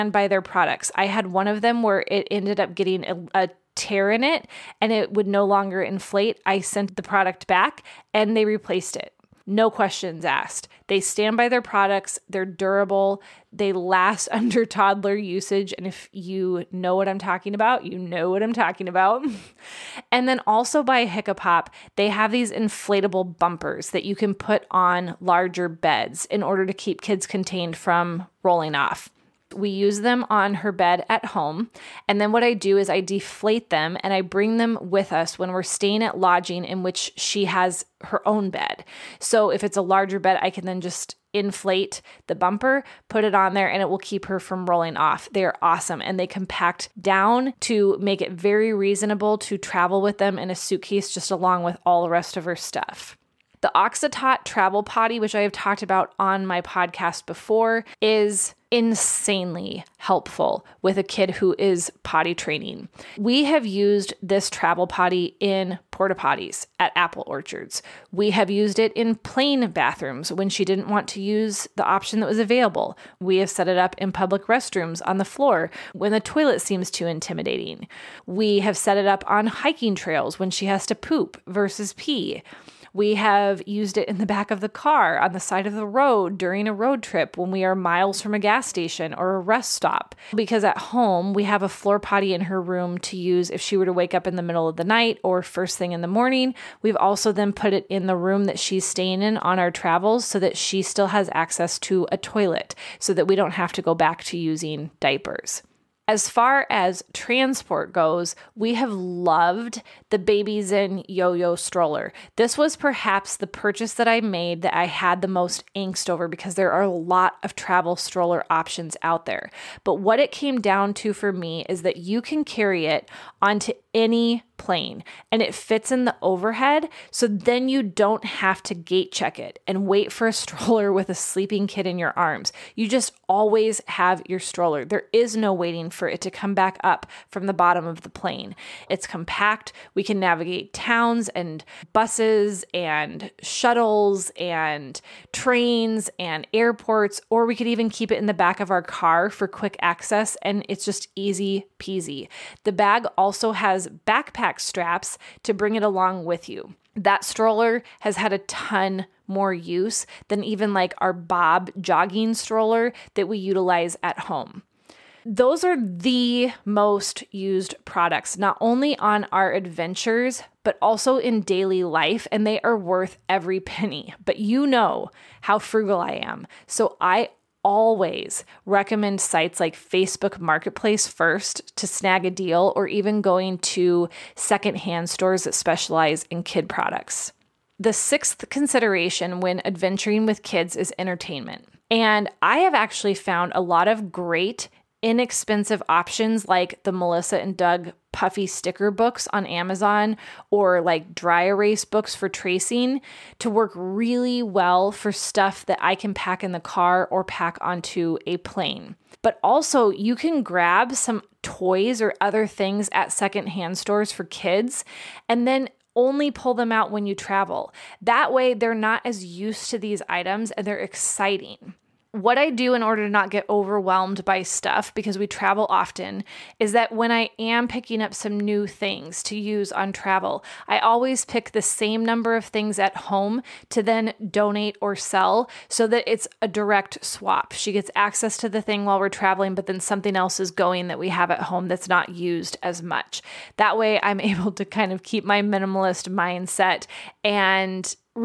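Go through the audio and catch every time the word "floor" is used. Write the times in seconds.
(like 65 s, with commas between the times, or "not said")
75 s, 91 s.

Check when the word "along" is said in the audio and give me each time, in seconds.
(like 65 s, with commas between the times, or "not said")
51 s, 155 s.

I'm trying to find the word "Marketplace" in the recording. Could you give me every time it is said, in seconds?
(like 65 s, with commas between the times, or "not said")
180 s.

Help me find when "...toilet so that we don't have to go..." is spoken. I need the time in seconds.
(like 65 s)
102 s.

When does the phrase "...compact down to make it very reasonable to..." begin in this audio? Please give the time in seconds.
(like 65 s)
46 s.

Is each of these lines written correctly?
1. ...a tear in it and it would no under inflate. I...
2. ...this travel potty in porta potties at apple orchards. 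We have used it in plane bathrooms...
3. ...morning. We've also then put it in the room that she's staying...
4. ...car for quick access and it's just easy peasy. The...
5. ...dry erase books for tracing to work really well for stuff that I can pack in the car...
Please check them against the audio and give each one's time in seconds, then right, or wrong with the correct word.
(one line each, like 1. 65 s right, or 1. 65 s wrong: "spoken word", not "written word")
1. 3 s wrong: "longer", not "under"
2. 64 s right
3. 96 s right
4. 148 s right
5. 201 s right.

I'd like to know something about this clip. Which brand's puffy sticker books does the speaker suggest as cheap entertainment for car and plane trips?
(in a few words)
Melissa and Doug.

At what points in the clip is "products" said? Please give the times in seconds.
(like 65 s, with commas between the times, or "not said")
0 s, 7 s, 11 s, 167 s, 186 s.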